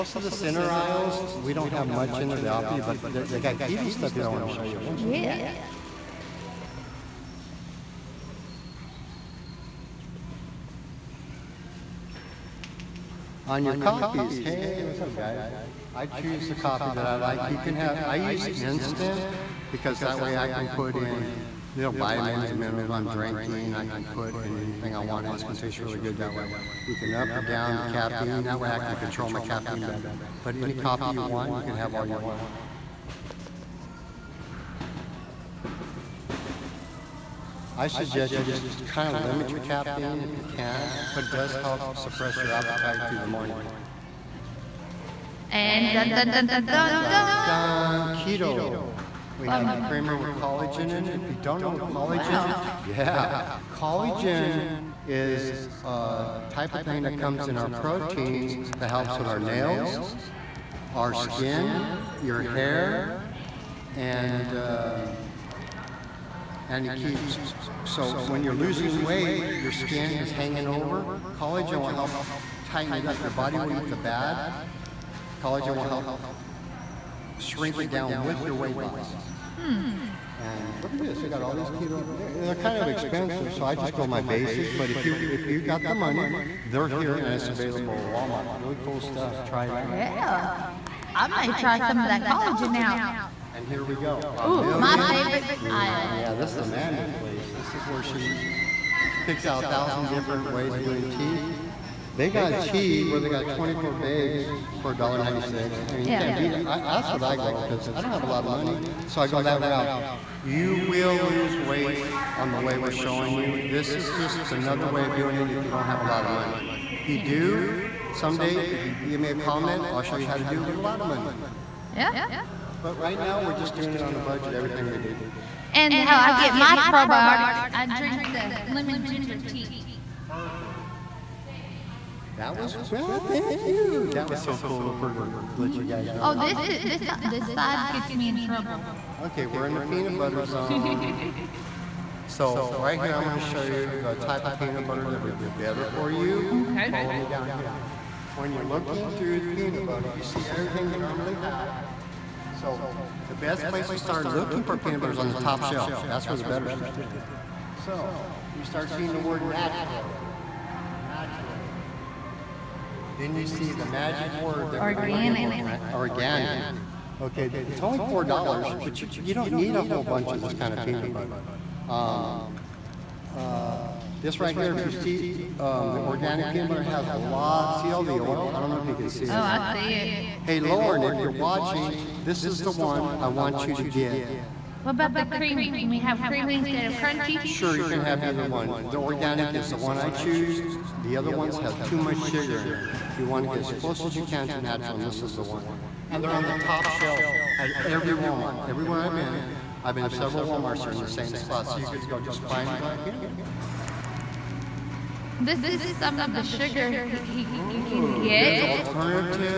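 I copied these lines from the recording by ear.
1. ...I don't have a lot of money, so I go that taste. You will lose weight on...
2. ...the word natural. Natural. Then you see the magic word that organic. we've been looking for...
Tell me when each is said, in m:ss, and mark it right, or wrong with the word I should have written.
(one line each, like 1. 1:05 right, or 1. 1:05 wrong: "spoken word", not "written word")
1. 1:47 wrong: "route", not "taste"
2. 2:39 right.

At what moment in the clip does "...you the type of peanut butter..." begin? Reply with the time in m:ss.
2:23.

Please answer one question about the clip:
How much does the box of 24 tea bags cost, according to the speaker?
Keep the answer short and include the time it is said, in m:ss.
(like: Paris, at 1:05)
$1.96, at 1:44.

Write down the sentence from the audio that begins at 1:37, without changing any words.
This is where she, she picks out a thousand different ways of doing tea.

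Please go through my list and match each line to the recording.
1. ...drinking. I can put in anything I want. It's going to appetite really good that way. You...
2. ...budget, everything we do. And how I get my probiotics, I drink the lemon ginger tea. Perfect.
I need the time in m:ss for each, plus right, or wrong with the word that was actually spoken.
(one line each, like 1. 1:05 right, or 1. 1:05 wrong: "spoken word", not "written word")
1. 0:23 wrong: "taste", not "appetite"
2. 2:04 right.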